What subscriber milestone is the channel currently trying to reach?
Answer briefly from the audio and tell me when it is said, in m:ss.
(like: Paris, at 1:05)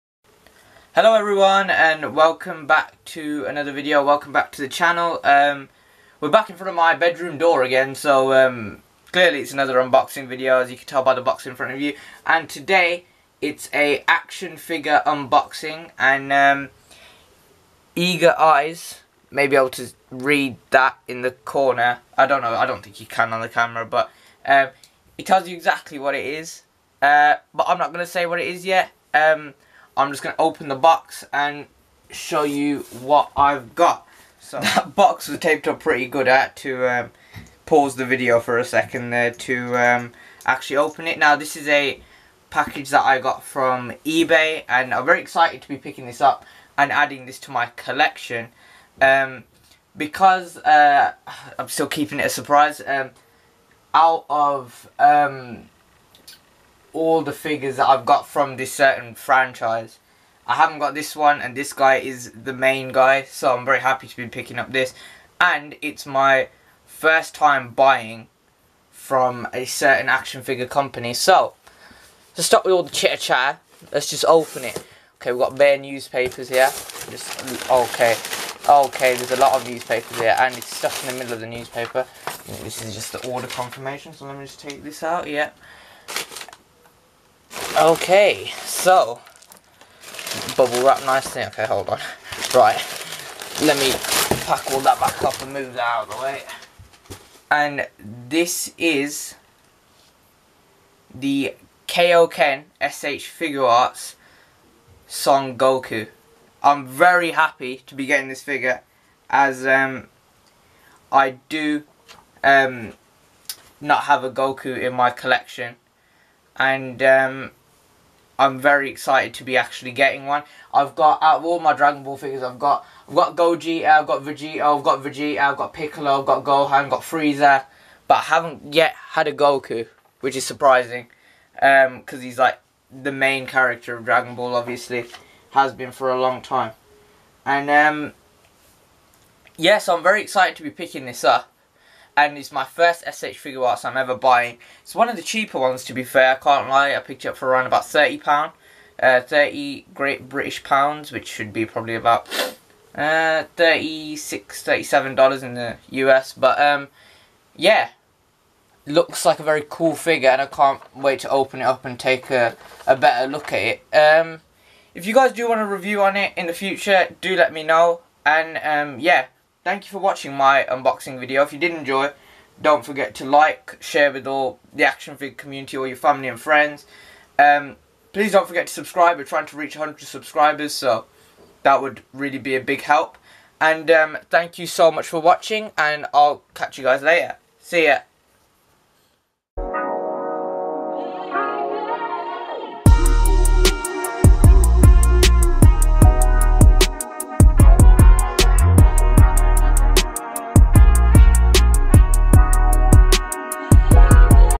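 100 subscribers, at 2:59.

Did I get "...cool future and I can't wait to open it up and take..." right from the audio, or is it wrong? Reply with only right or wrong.
wrong.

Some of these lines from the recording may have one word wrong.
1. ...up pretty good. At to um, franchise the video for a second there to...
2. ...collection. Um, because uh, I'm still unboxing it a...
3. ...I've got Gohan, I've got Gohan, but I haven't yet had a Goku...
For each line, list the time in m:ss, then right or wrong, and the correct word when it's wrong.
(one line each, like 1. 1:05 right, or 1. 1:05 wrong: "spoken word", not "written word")
1. 0:35 wrong: "pause", not "franchise"
2. 0:47 wrong: "keeping", not "unboxing"
3. 2:06 wrong: "Frieza", not "Gohan".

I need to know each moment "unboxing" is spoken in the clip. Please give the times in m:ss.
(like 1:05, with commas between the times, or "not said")
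0:09, 0:15, 2:50.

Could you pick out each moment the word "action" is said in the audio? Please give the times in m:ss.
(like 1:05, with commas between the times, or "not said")
0:14, 1:10, 2:54.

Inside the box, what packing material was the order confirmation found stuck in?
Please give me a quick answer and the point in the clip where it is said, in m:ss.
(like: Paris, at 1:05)
Newspaper, at 1:21.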